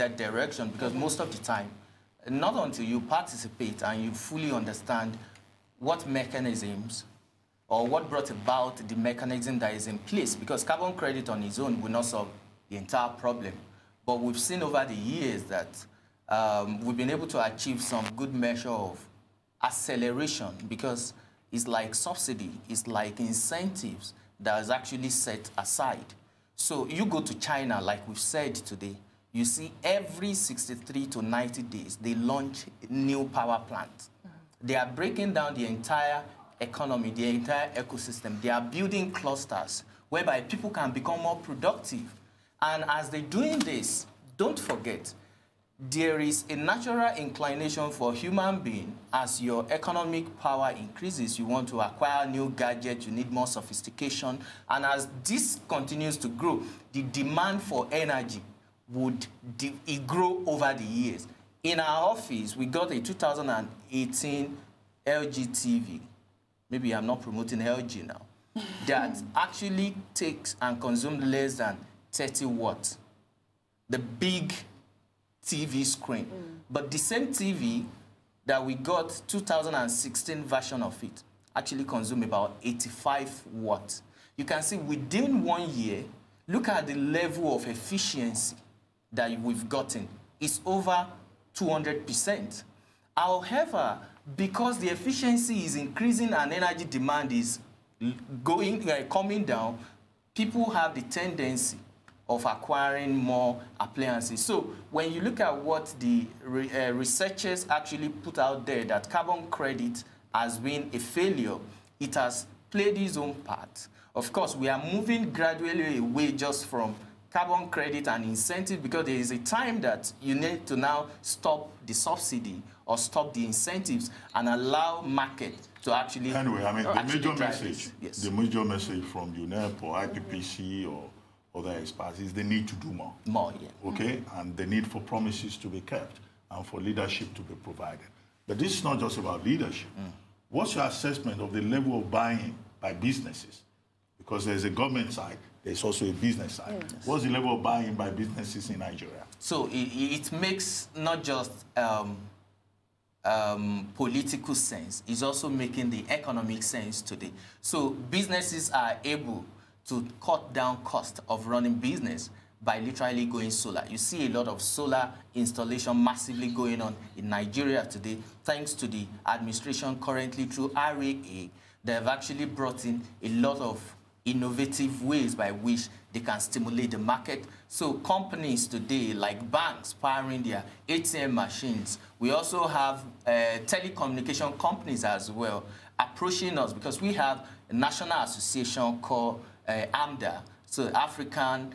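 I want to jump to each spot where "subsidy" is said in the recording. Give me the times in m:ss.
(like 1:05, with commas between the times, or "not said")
0:21, 2:01.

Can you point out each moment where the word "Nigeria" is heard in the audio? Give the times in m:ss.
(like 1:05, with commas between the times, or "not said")
2:28, 2:47.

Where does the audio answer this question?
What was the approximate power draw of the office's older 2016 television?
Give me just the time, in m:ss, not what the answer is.
1:22.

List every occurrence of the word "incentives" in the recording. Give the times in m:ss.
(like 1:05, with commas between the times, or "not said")
0:23, 1:58, 2:03.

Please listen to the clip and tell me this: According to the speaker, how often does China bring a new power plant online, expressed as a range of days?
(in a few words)
63 to 90 days.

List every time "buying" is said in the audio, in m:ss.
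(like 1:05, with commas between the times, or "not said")
2:22, 2:27.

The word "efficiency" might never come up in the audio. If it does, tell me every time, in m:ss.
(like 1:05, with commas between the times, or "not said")
1:27, 1:34.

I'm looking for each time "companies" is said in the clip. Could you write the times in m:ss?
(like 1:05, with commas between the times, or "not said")
2:57, 3:04.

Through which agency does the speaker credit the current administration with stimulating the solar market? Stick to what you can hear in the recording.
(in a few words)
REA.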